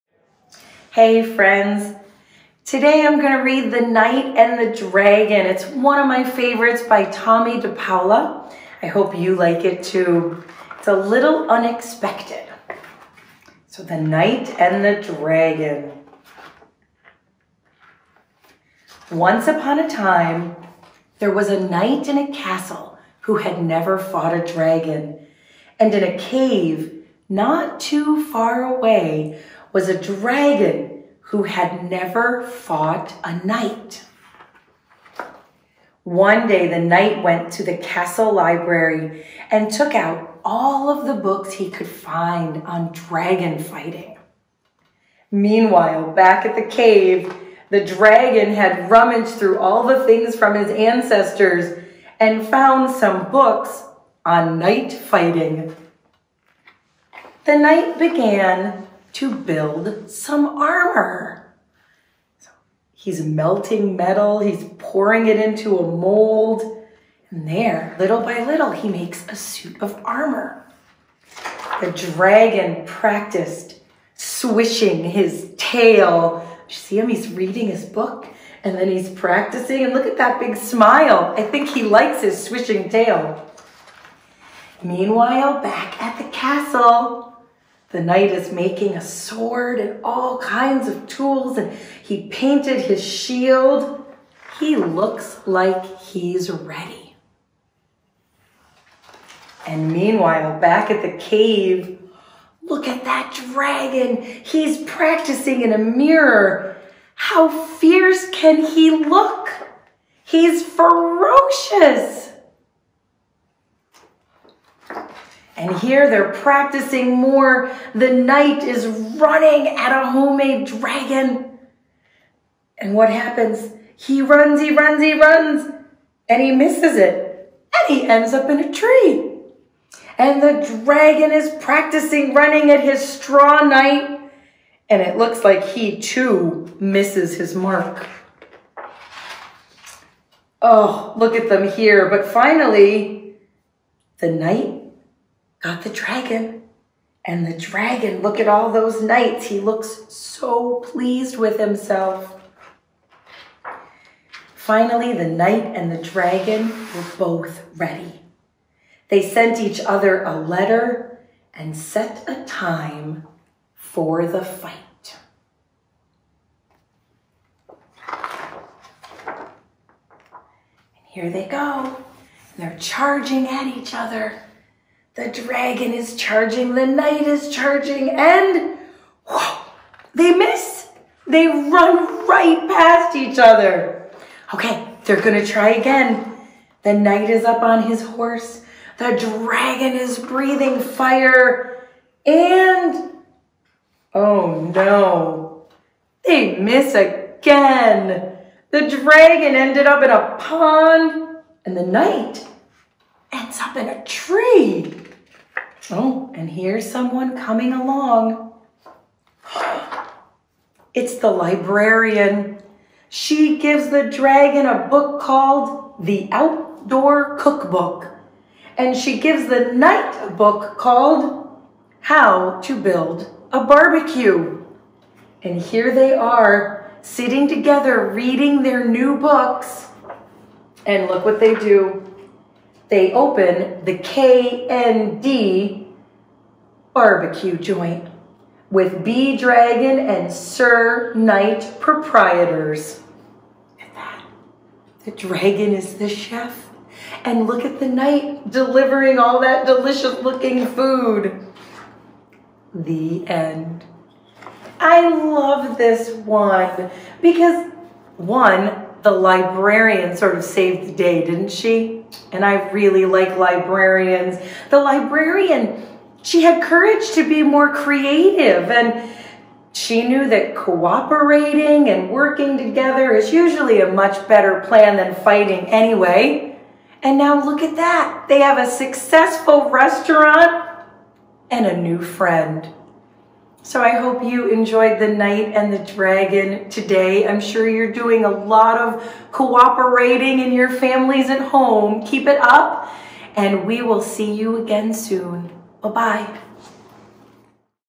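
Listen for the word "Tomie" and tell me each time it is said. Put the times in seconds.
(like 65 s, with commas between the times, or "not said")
7 s.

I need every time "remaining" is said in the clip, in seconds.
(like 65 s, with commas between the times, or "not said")
not said.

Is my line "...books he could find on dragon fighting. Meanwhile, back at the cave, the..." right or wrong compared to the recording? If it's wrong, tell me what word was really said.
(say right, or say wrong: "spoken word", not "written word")
right.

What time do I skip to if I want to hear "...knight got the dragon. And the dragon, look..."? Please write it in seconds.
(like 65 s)
144 s.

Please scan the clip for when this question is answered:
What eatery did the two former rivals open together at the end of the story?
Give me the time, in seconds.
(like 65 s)
233 s.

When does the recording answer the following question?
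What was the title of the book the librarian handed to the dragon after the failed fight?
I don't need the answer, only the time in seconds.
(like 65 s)
216 s.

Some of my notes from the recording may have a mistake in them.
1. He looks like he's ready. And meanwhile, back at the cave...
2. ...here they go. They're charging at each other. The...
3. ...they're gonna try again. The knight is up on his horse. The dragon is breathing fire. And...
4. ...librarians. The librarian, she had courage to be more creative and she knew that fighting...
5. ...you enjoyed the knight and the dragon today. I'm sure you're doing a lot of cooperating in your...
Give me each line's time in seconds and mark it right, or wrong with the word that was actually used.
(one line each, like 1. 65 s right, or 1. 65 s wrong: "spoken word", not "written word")
1. 94 s right
2. 171 s right
3. 185 s right
4. 263 s wrong: "cooperating", not "fighting"
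5. 284 s right.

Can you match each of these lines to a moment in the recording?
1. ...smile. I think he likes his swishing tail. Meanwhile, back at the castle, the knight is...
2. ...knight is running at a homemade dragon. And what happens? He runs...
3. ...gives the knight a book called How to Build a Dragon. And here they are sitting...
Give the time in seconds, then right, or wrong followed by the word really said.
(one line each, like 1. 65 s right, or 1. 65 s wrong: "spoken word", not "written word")
1. 80 s right
2. 118 s right
3. 219 s wrong: "Barbecue", not "Dragon".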